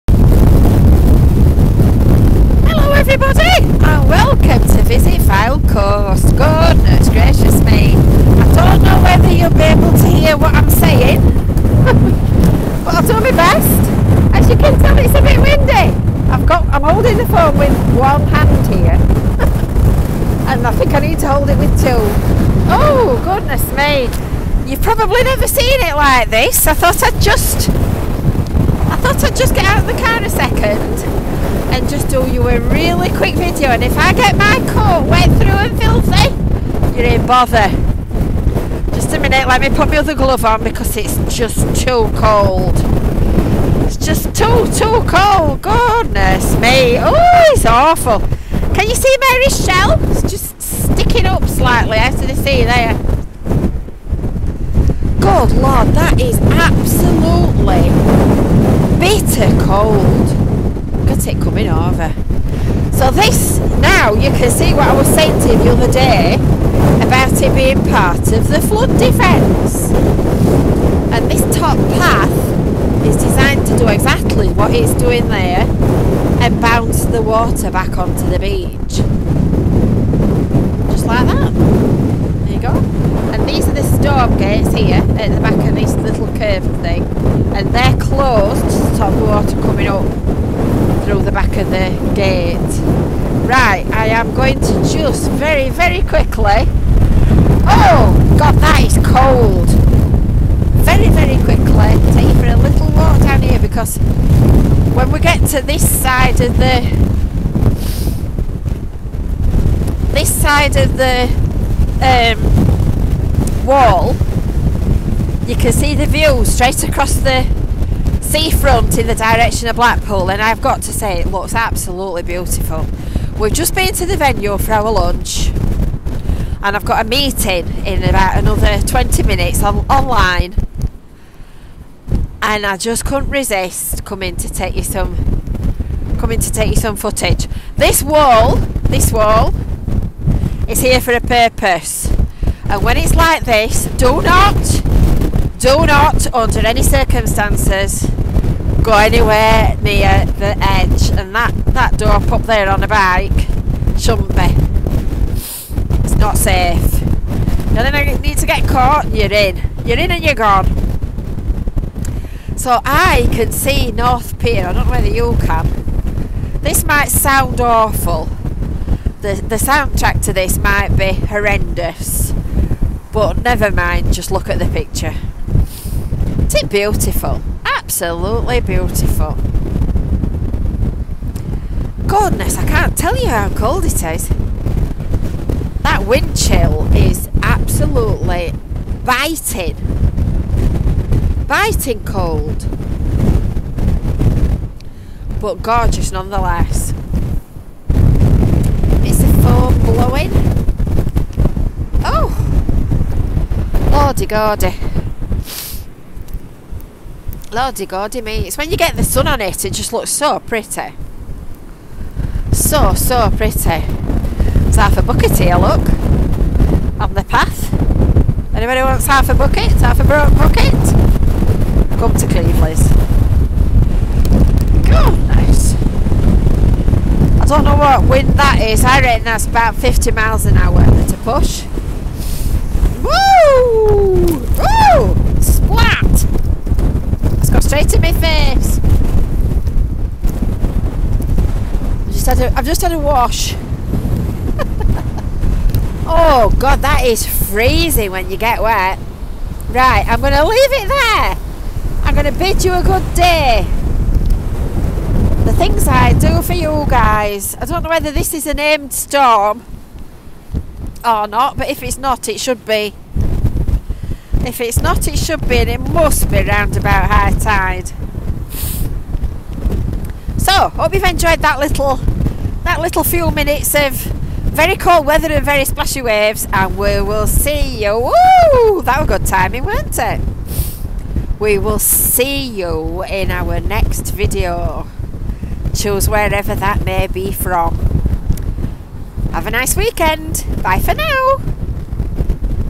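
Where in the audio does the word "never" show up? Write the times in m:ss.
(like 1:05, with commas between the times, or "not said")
0:25, 2:53.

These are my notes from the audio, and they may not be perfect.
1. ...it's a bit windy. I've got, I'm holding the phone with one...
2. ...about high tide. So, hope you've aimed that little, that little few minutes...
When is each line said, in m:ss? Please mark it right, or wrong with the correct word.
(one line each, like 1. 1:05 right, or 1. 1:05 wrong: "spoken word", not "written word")
1. 0:14 right
2. 4:26 wrong: "enjoyed", not "aimed".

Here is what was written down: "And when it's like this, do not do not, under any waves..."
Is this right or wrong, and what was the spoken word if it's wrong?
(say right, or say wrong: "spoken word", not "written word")
wrong: "circumstances", not "waves".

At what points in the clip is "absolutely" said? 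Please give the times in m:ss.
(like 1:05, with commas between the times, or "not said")
0:56, 2:01, 2:57, 3:07.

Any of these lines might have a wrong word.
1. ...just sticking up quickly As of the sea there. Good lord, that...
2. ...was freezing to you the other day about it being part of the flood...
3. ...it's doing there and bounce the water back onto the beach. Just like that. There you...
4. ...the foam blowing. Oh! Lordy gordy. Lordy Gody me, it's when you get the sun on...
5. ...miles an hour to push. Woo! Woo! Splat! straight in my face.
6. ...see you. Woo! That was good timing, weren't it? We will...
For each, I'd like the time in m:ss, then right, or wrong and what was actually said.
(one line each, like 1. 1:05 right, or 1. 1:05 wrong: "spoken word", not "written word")
1. 0:50 wrong: "slightly", not "quickly"
2. 1:04 wrong: "saying", not "freezing"
3. 1:14 right
4. 3:19 right
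5. 3:50 right
6. 4:37 right.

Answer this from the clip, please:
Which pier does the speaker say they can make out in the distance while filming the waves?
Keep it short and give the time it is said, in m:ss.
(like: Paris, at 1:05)
North Pier, at 2:43.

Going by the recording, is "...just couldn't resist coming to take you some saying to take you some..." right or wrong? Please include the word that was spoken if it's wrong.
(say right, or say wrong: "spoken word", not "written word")
wrong: "coming", not "saying".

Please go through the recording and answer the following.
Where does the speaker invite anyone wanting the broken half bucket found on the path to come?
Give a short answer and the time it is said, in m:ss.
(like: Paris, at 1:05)
Cleveleys, at 3:42.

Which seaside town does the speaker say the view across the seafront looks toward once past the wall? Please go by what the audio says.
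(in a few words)
Blackpool.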